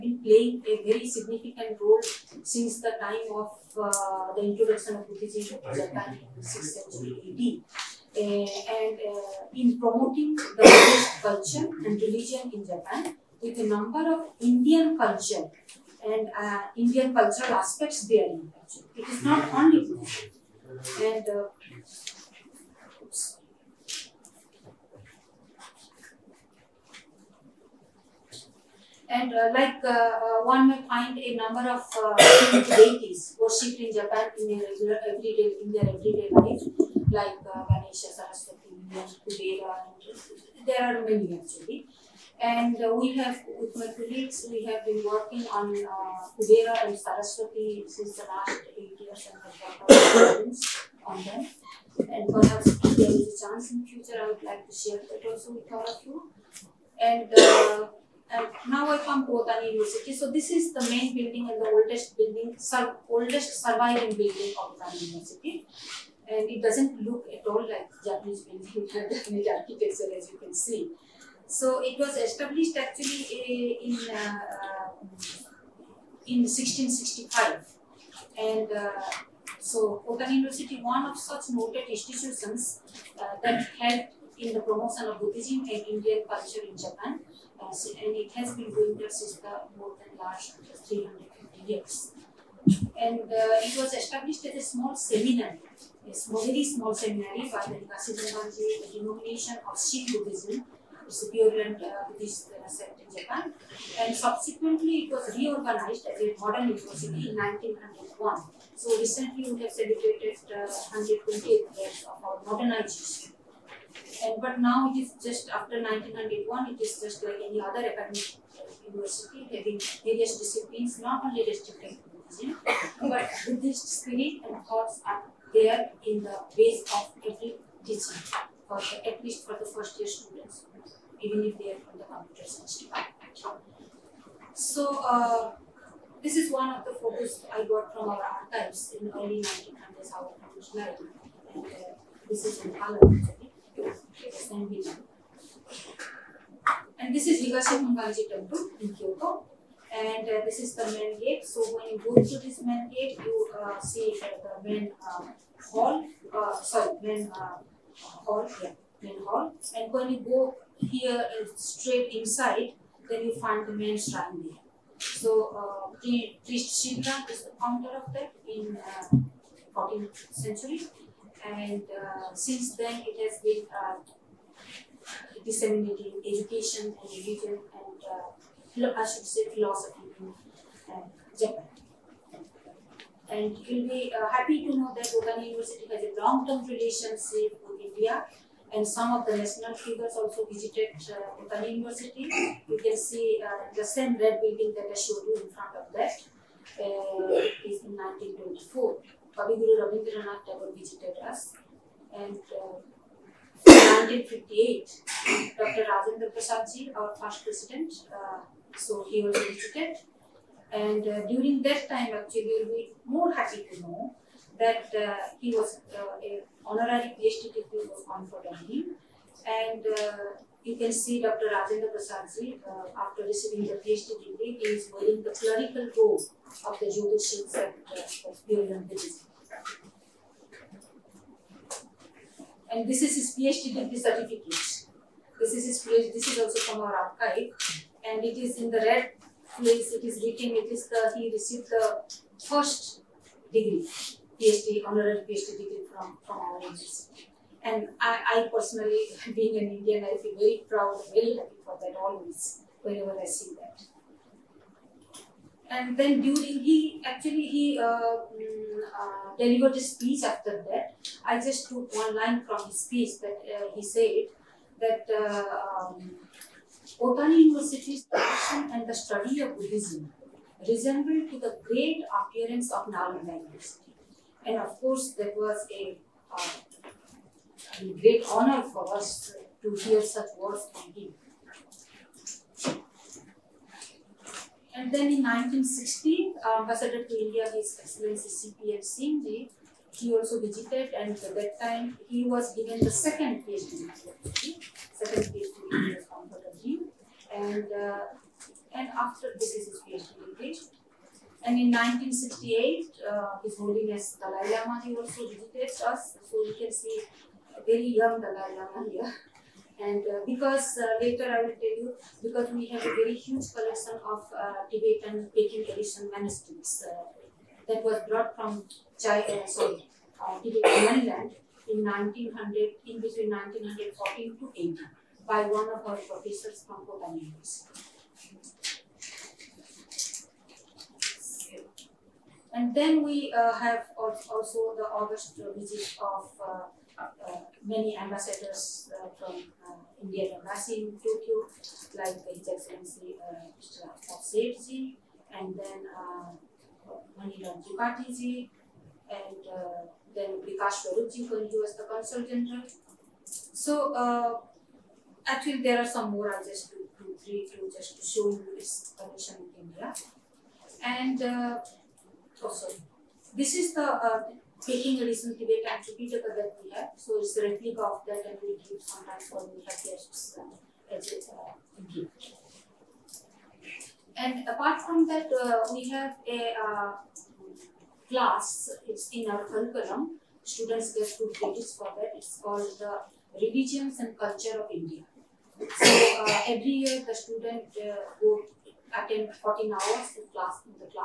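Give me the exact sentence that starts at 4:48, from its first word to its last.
Singh he also visited and at that time he was given the second PhD, second PhD from Bhattabji.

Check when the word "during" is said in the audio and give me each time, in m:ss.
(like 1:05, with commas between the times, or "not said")
3:31, 4:16.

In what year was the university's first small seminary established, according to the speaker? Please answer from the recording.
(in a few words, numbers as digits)
1665.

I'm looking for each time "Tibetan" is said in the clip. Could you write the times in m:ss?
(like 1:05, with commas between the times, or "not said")
5:14, 5:20.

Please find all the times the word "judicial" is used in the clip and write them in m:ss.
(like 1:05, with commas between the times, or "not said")
3:46.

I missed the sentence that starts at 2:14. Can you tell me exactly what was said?
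So uh, this is one of the photos I got from our archives in early 1900s, our revolutionary.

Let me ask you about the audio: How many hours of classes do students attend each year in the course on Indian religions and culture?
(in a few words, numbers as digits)
14 hours.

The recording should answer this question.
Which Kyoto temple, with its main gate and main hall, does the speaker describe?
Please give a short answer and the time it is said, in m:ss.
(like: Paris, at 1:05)
Higashi Honganji Temple, at 2:27.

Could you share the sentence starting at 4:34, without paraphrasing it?
And of course, that was a, uh, a great honor for us to hear such words from him.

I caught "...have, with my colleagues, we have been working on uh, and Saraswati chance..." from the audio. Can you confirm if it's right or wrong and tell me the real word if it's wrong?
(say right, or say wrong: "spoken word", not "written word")
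wrong: "since", not "chance".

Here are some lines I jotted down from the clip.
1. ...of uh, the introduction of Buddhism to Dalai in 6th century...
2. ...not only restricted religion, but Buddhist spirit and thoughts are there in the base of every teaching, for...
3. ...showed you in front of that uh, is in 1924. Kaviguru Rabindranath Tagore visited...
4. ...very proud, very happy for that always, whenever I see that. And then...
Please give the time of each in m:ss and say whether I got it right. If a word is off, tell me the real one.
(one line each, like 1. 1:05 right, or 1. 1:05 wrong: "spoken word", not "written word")
1. 0:03 wrong: "Japan", not "Dalai"
2. 2:00 right
3. 3:14 right
4. 4:10 right.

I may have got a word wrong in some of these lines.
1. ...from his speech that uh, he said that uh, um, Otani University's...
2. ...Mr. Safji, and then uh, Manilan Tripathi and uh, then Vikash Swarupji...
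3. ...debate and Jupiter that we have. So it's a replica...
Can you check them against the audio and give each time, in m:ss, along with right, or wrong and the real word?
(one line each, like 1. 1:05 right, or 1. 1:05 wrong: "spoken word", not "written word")
1. 4:22 right
2. 5:43 right
3. 6:05 right.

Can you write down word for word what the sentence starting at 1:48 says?
So recently, we have celebrated uh, 120th years of our modernization.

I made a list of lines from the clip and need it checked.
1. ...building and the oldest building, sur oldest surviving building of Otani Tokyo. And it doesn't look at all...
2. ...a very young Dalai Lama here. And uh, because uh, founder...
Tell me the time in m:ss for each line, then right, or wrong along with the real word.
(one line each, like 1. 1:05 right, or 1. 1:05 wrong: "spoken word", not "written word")
1. 1:01 wrong: "University", not "Tokyo"
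2. 5:07 wrong: "later", not "founder".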